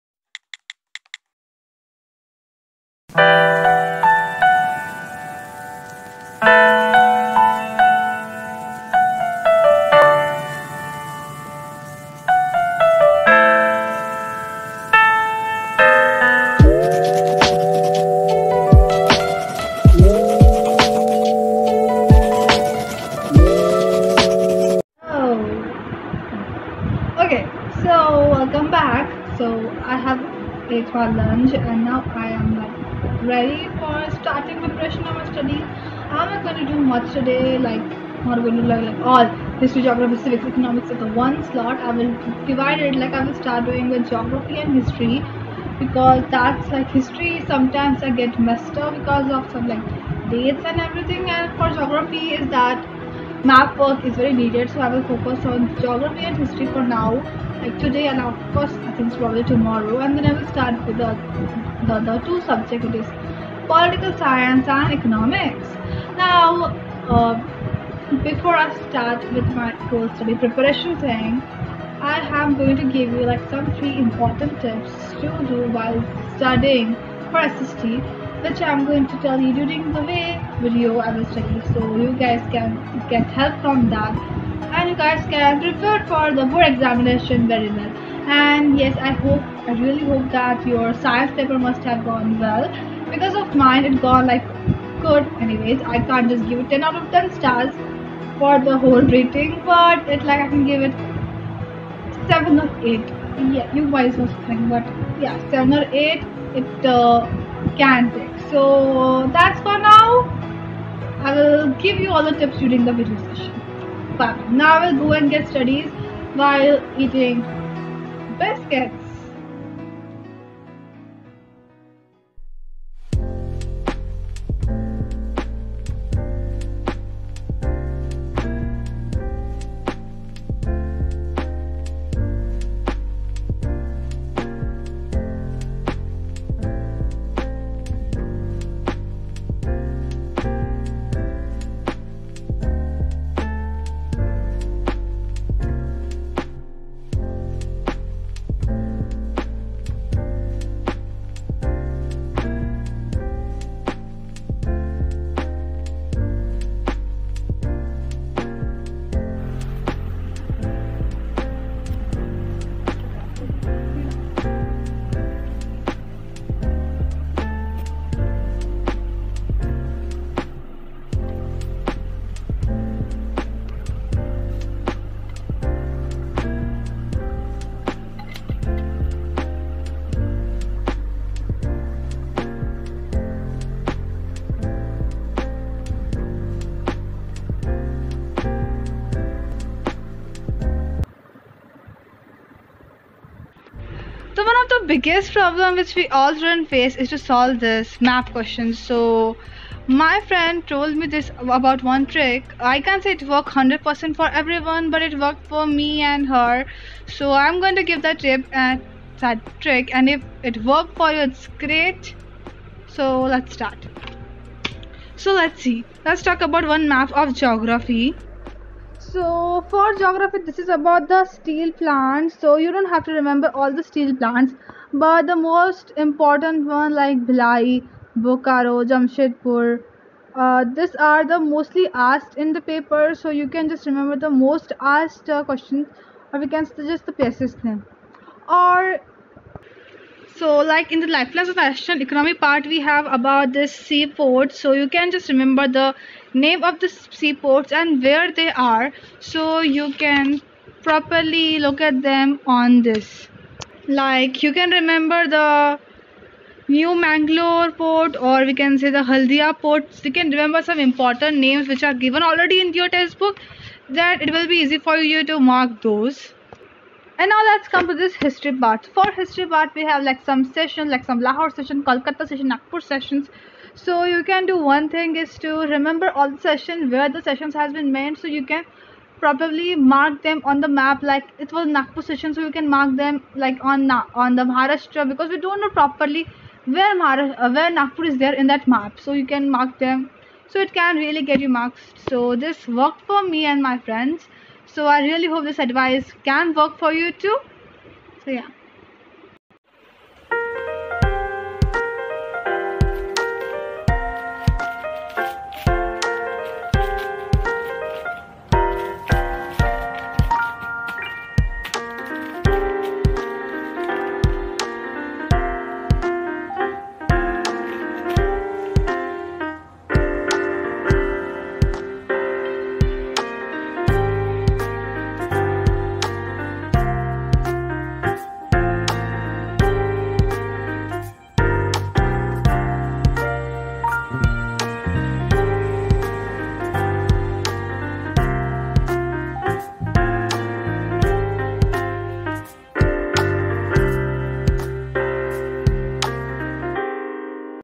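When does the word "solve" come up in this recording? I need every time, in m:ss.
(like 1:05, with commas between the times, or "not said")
3:17.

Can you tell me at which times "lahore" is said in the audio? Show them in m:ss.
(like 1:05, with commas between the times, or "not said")
4:31.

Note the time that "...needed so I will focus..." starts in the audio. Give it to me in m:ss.
0:54.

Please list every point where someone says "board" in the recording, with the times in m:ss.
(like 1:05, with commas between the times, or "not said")
1:26.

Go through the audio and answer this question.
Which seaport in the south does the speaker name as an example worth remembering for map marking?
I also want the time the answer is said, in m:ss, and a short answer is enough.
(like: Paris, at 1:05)
New Mangalore port, at 4:16.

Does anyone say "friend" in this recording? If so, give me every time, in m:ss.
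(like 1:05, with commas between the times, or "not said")
3:20, 4:53.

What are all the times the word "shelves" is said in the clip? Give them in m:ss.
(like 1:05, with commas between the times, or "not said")
not said.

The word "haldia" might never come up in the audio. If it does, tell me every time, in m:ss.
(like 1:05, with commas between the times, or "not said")
4:19.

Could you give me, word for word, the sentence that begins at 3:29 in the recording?
And if it worked for you, it's great.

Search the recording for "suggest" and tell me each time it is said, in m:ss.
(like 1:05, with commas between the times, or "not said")
3:56.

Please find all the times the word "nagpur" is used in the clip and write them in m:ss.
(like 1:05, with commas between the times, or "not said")
4:32, 4:41, 4:47.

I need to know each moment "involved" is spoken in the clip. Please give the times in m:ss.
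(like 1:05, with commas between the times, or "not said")
not said.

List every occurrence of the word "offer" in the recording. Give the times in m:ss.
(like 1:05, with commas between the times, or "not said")
not said.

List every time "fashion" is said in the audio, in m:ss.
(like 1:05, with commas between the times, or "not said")
4:01.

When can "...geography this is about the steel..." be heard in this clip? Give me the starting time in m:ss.
3:39.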